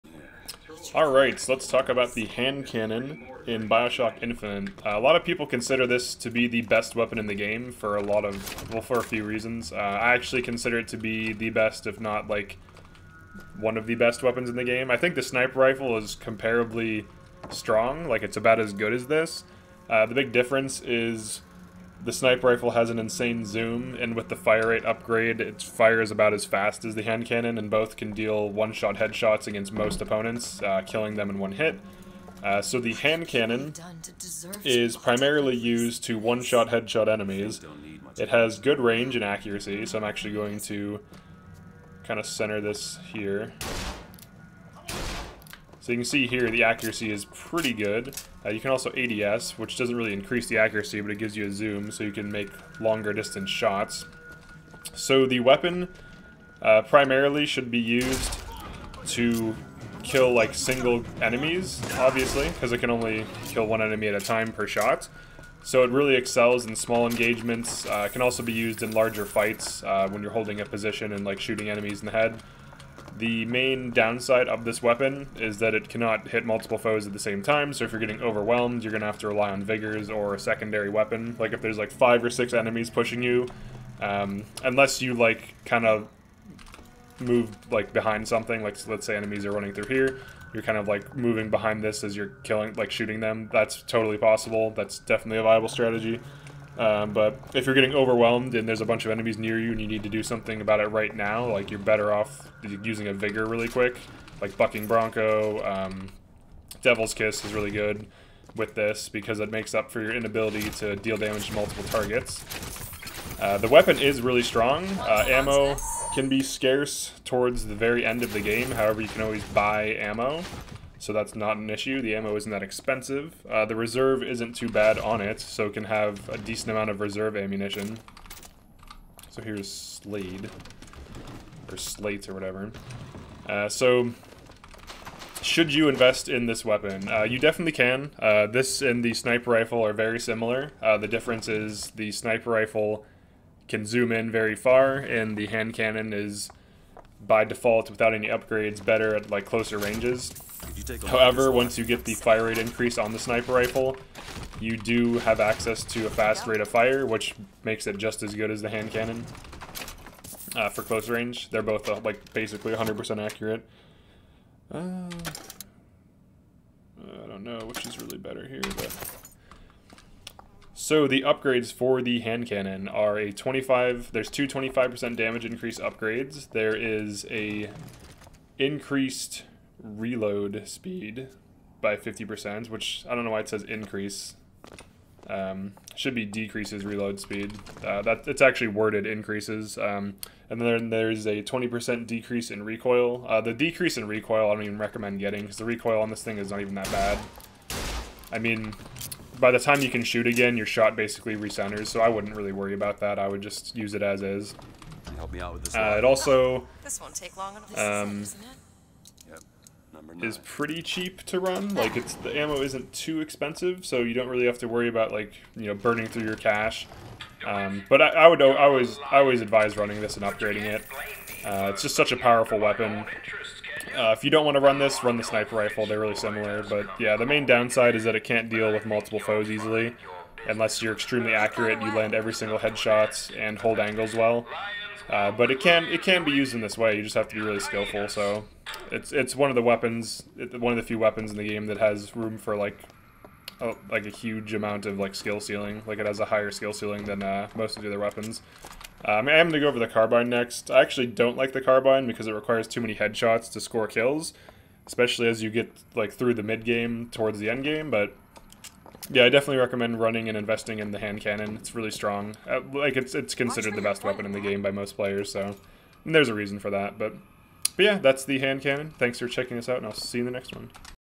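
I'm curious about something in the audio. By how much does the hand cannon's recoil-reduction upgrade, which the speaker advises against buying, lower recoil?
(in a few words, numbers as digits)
20%.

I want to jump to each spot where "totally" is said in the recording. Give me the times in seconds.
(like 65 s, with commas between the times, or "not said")
93 s.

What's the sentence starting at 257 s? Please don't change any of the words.
But yeah, I definitely recommend running and investing in the hand cannon.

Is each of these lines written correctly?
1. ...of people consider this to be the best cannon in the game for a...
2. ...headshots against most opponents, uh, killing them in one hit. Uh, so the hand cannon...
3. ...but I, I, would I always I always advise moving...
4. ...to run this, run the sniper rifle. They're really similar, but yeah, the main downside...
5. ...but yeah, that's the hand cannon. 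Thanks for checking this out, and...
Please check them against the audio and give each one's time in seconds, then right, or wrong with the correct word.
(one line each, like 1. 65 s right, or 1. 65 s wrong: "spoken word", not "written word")
1. 5 s wrong: "weapon", not "cannon"
2. 28 s right
3. 217 s wrong: "running", not "moving"
4. 224 s right
5. 267 s right.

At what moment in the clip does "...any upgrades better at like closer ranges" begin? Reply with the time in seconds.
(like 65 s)
148 s.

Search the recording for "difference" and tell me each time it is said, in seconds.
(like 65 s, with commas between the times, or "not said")
20 s, 141 s.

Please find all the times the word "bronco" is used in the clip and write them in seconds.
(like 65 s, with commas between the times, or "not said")
104 s.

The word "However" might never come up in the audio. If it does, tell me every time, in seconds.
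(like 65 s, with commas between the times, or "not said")
118 s, 151 s.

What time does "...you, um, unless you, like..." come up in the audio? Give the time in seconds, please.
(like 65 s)
83 s.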